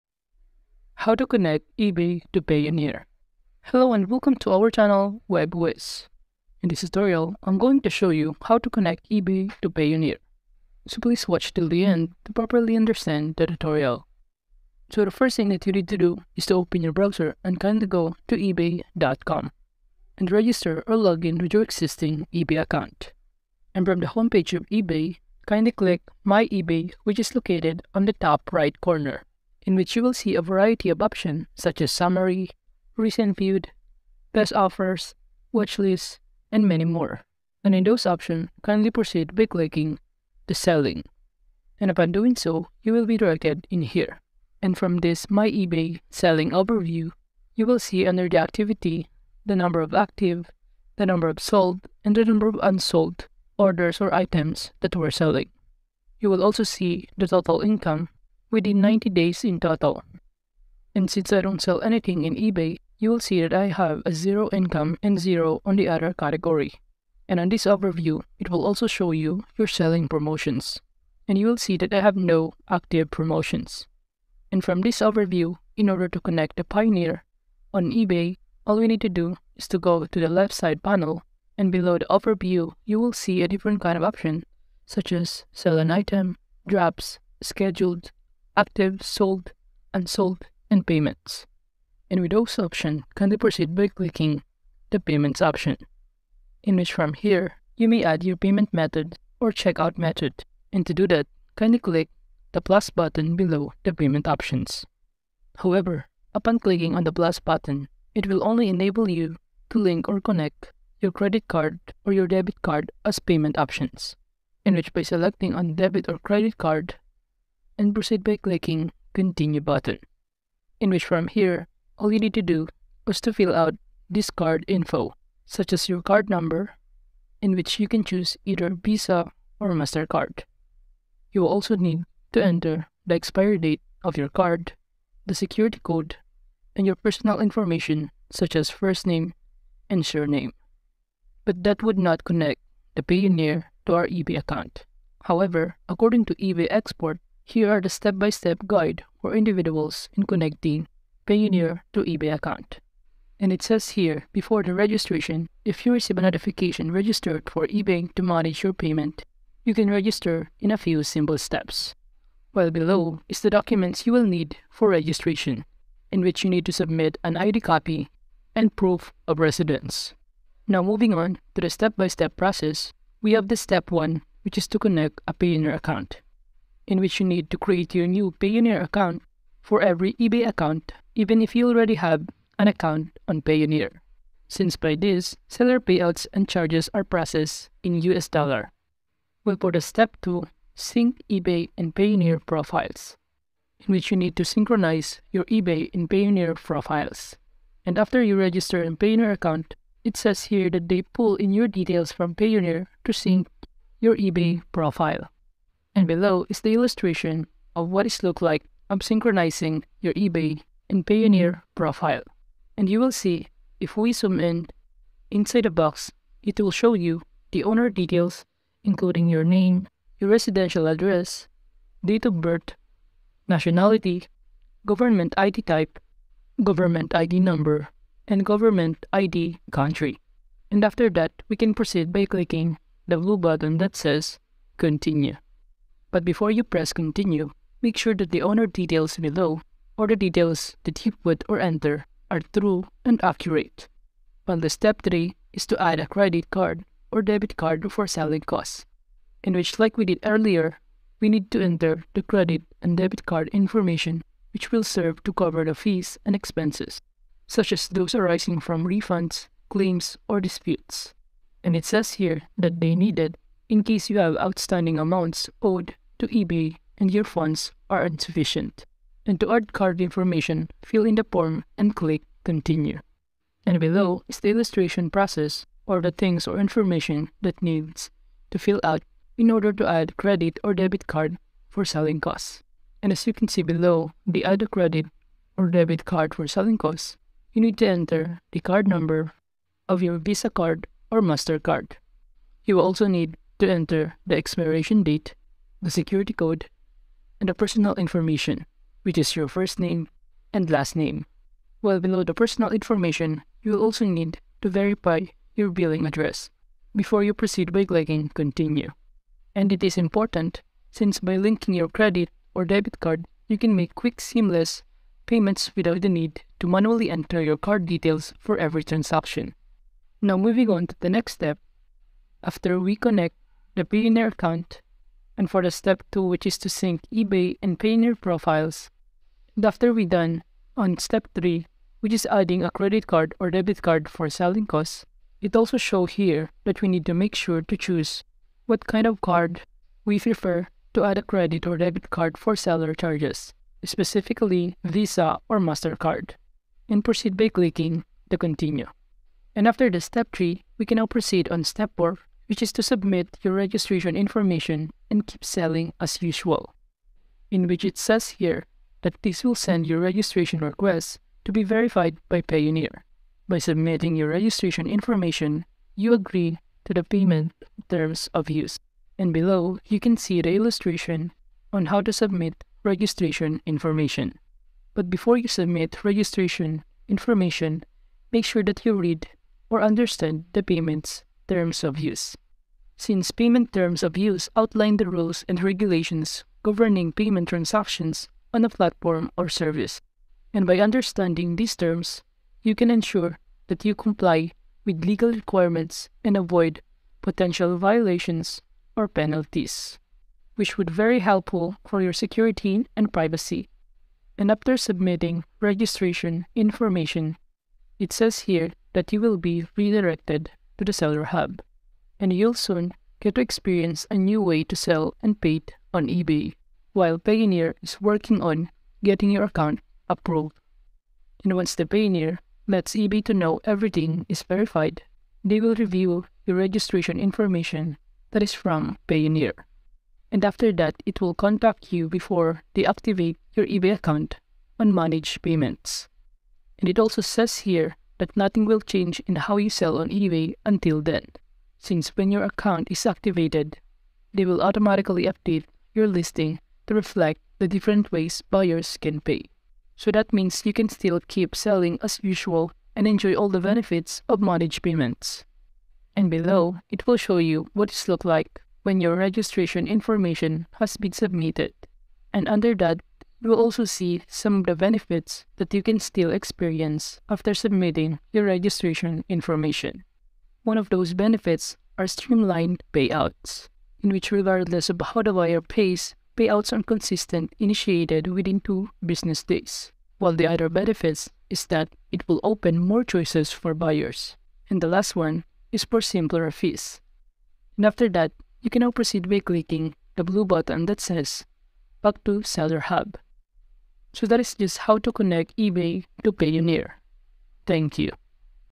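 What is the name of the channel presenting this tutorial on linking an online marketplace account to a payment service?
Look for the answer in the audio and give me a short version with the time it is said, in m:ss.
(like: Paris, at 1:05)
Web Whizz, at 0:05.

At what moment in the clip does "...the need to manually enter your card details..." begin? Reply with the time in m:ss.
5:16.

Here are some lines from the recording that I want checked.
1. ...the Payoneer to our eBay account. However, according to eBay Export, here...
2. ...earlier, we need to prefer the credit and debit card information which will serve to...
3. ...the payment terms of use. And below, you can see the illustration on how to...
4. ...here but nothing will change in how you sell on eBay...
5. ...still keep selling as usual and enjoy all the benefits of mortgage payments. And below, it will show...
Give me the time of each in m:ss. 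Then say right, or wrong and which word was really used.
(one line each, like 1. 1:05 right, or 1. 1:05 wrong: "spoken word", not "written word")
1. 2:22 right
2. 4:10 wrong: "enter", not "prefer"
3. 6:06 right
4. 7:17 right
5. 7:30 right.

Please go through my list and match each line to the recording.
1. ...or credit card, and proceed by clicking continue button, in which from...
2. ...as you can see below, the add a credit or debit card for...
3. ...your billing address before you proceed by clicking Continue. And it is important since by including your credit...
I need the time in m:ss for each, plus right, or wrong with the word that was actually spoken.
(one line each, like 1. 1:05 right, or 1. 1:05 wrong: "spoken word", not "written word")
1. 1:56 right
2. 4:43 right
3. 5:05 wrong: "linking", not "including".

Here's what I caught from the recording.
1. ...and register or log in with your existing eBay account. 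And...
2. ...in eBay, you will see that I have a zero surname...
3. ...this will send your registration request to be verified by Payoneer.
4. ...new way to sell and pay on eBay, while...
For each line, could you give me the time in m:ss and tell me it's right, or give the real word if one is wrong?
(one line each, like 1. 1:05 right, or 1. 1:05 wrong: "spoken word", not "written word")
1. 0:20 right
2. 1:02 wrong: "income", not "surname"
3. 5:59 right
4. 6:54 right.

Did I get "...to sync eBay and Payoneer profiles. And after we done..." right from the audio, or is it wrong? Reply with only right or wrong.
right.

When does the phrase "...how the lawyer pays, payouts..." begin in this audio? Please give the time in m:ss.
7:55.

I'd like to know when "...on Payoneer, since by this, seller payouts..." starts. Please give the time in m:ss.
3:03.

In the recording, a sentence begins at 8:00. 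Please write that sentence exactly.
While the other benefits is that it will open more choices for buyers.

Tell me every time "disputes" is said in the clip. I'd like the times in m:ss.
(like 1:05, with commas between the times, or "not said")
4:20.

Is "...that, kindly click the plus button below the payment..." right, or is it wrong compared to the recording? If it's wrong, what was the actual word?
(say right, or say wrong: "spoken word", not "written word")
right.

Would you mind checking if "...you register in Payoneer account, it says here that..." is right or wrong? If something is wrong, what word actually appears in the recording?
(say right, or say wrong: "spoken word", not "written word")
right.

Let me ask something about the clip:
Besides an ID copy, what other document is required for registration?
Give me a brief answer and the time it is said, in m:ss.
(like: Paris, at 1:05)
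proof of residence, at 2:48.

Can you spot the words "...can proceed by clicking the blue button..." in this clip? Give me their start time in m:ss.
3:51.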